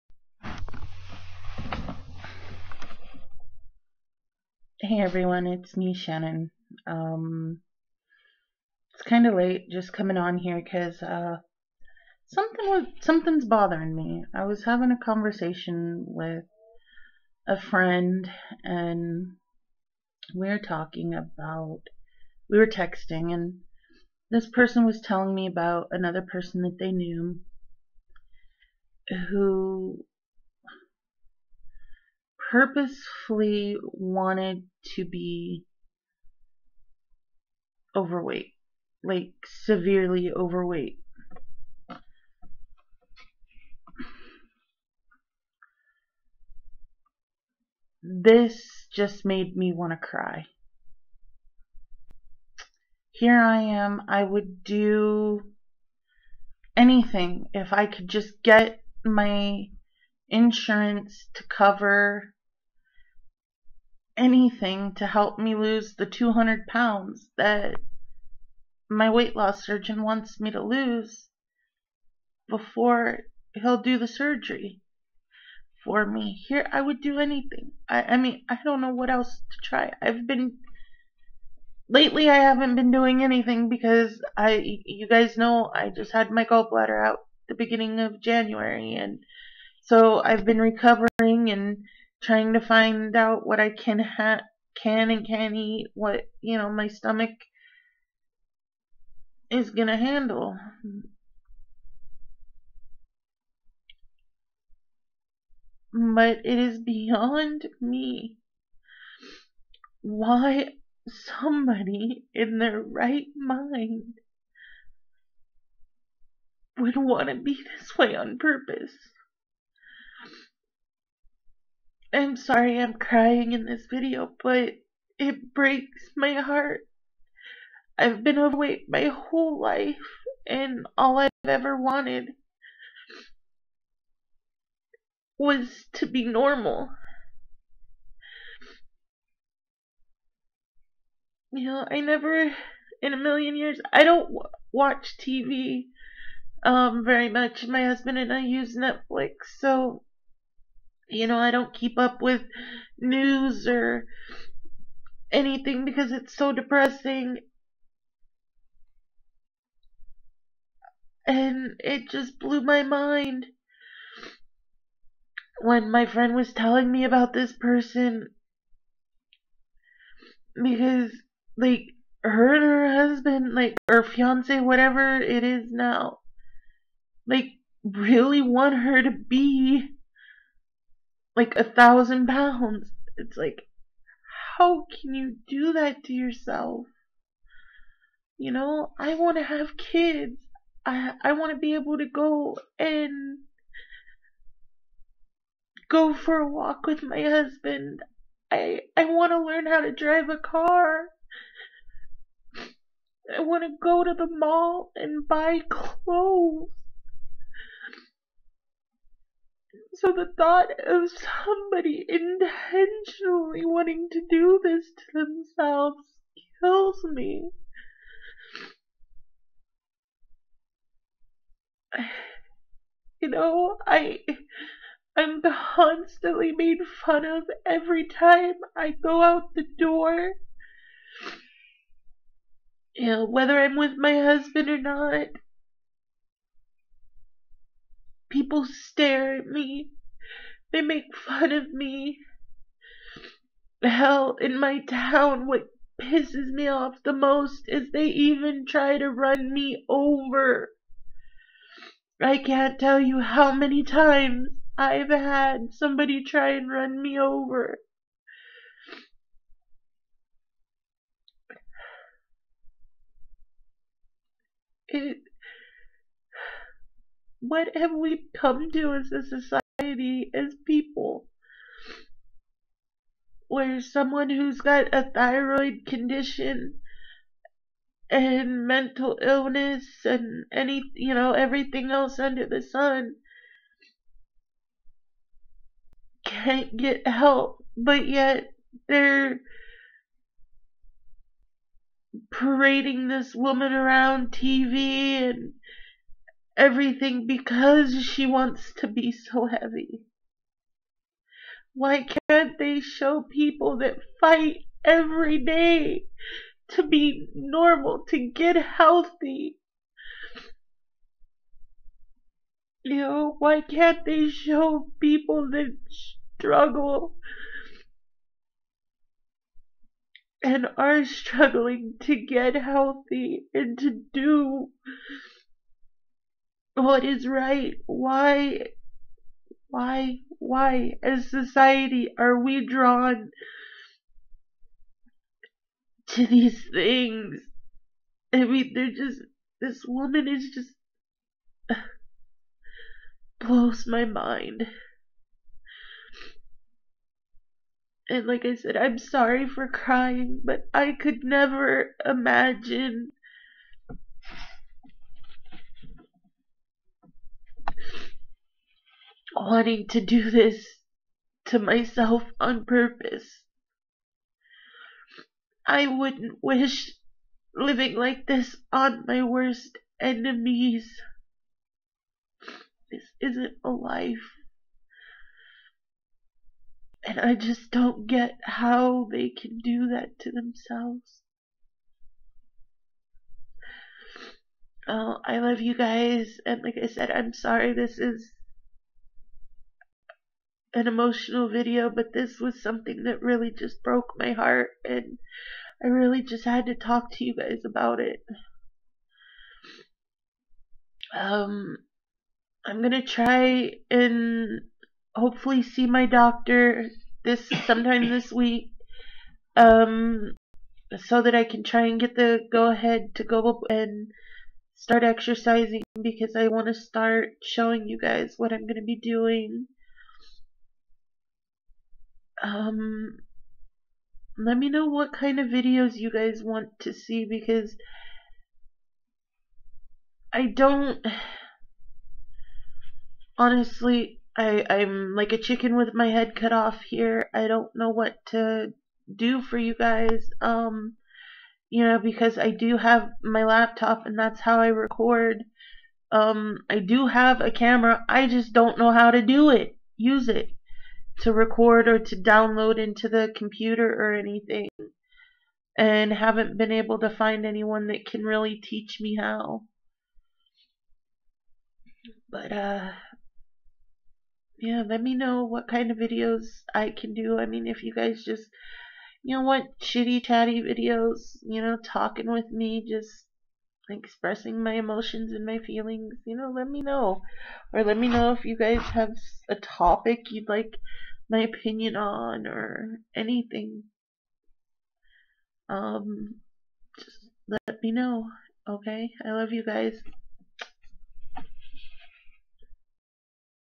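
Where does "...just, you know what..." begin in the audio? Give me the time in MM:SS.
07:48.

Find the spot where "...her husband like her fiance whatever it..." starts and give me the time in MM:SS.
02:52.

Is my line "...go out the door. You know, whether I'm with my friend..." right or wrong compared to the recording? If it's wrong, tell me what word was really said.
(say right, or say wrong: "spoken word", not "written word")
wrong: "husband", not "friend".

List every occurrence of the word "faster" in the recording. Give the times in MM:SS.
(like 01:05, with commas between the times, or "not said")
not said.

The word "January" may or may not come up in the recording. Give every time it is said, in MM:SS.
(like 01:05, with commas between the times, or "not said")
01:28.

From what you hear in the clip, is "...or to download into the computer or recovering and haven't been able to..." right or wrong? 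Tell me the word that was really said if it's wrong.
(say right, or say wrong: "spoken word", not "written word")
wrong: "anything", not "recovering".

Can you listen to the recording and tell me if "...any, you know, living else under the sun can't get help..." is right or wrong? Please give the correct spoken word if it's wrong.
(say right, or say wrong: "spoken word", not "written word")
wrong: "everything", not "living".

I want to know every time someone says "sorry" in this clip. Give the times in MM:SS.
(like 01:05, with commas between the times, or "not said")
02:02, 05:48, 06:27.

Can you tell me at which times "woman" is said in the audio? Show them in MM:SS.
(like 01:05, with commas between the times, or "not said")
04:53, 05:39.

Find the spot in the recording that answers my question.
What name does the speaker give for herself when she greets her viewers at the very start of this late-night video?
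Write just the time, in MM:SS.
00:05.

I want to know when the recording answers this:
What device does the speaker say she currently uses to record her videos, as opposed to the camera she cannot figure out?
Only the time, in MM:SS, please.
07:23.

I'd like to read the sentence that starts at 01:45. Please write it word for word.
But it is beyond me why somebody in their right mind would want to be this way on purpose.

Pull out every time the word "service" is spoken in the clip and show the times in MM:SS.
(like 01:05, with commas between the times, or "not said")
not said.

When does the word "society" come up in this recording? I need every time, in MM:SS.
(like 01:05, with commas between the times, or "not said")
04:29, 05:31.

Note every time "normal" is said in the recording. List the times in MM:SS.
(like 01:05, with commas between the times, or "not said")
02:16, 05:07.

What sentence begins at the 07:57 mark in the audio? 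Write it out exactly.
Or let me know if you guys have a topic you'd like my opinion on or anything.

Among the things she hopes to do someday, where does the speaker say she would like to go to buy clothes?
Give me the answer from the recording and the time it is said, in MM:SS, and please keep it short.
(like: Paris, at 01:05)
the mall, at 03:24.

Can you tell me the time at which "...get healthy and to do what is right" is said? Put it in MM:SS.
05:22.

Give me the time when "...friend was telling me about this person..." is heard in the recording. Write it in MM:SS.
02:46.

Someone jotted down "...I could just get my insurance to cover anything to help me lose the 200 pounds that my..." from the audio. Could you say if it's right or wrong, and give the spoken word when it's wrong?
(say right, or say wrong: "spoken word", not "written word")
right.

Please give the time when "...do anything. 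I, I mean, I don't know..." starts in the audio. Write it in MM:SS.
01:17.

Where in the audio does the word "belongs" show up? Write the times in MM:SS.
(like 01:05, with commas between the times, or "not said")
not said.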